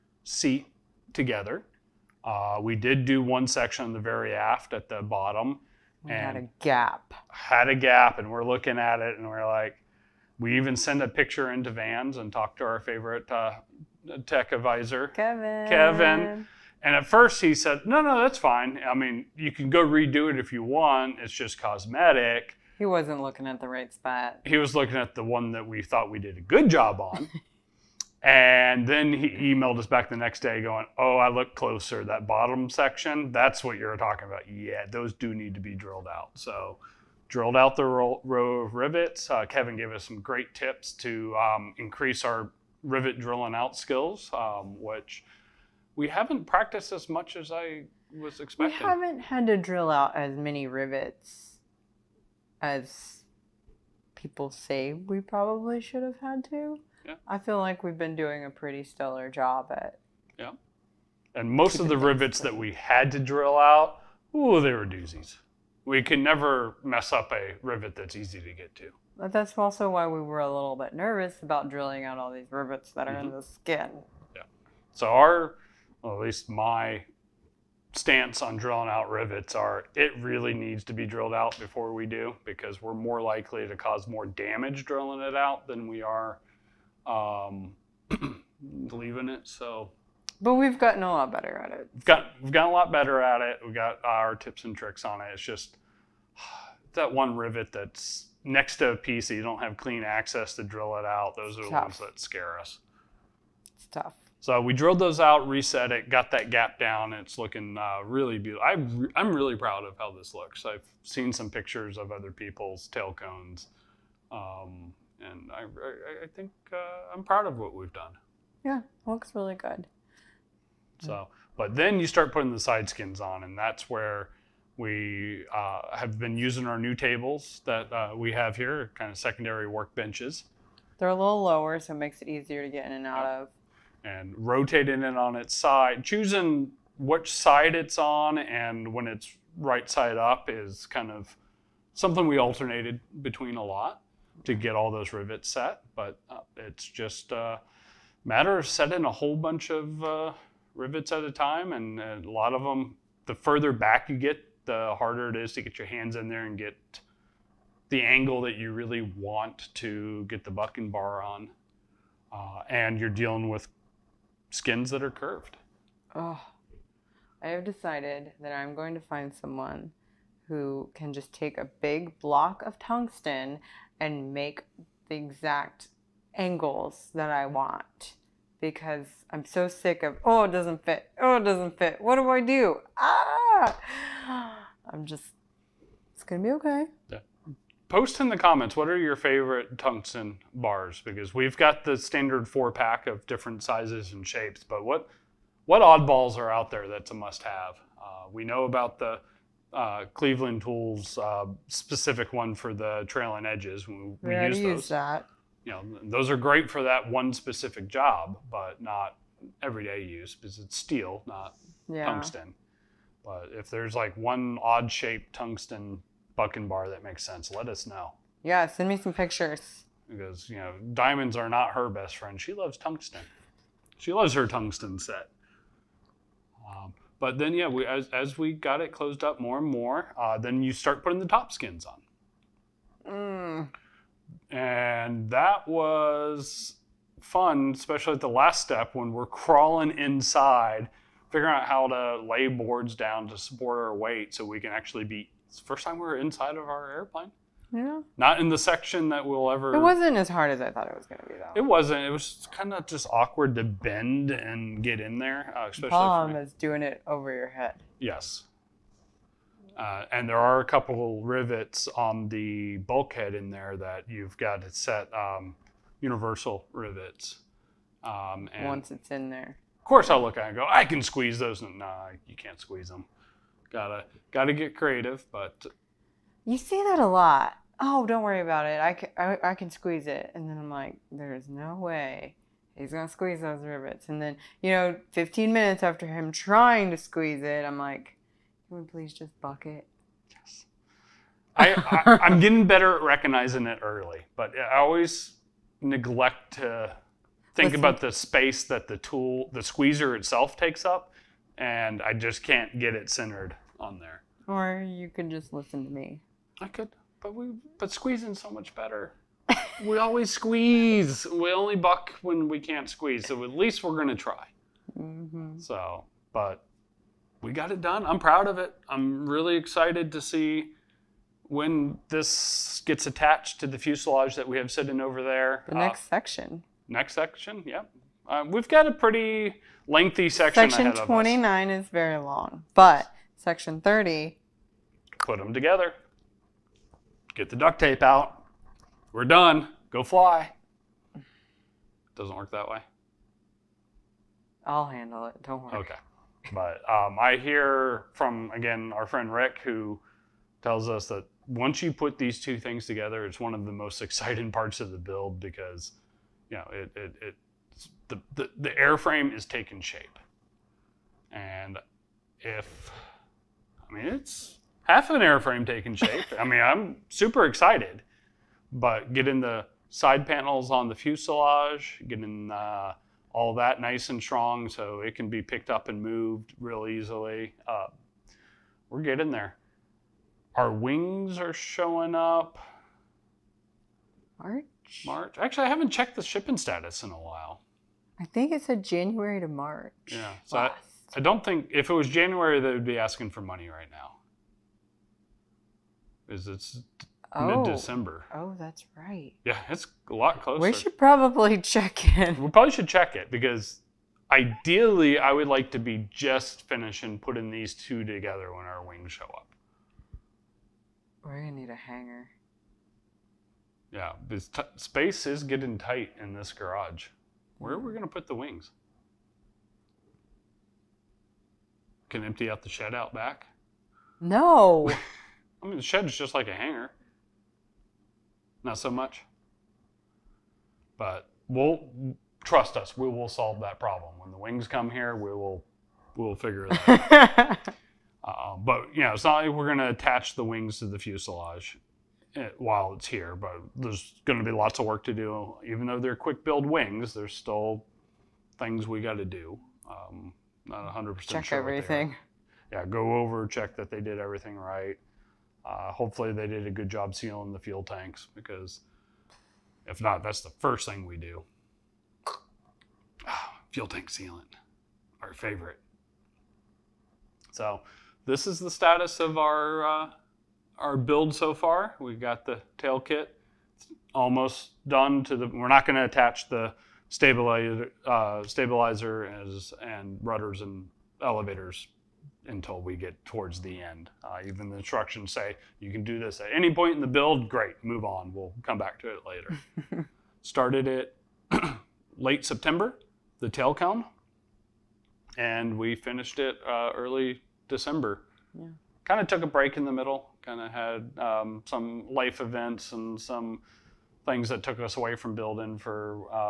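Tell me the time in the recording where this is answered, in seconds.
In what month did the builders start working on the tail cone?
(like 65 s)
492 s.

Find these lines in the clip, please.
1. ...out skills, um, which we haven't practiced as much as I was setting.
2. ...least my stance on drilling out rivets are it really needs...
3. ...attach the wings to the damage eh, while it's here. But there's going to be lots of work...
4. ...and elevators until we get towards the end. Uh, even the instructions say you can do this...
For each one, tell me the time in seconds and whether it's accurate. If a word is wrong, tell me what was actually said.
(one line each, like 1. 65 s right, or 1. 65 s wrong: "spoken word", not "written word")
1. 43 s wrong: "expecting", not "setting"
2. 76 s right
3. 439 s wrong: "fuselage", not "damage"
4. 480 s right.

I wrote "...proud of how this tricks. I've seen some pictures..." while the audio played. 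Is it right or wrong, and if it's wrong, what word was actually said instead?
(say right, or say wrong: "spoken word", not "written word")
wrong: "looks", not "tricks".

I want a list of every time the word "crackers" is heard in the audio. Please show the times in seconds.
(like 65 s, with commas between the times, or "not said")
not said.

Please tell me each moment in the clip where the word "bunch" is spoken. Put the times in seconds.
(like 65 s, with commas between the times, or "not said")
149 s.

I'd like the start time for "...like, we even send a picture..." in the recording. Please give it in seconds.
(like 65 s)
9 s.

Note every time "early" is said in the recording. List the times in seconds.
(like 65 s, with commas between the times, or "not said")
293 s, 496 s.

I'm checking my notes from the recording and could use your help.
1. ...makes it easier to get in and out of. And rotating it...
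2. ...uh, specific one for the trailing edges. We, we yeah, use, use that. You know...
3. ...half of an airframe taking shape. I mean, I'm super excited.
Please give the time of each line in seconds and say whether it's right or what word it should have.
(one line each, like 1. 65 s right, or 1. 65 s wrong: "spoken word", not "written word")
1. 131 s right
2. 201 s right
3. 364 s right.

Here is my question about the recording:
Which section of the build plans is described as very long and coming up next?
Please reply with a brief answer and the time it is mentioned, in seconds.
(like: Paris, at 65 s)
Section 29, at 330 s.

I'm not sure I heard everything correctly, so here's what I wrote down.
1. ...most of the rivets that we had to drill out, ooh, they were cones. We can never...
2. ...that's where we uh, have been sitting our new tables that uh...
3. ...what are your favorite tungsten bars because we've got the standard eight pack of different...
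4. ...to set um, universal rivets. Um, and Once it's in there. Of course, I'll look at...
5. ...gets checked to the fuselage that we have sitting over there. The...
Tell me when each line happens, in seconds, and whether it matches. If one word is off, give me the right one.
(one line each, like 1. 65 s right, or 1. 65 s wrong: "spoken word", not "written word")
1. 61 s wrong: "doozies", not "cones"
2. 123 s wrong: "using", not "sitting"
3. 188 s wrong: "four", not "eight"
4. 264 s right
5. 322 s wrong: "attached", not "checked".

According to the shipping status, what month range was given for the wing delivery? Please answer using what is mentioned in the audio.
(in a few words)
January to March.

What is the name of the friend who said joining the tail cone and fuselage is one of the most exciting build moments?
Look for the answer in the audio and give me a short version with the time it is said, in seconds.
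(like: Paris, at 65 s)
Rick, at 349 s.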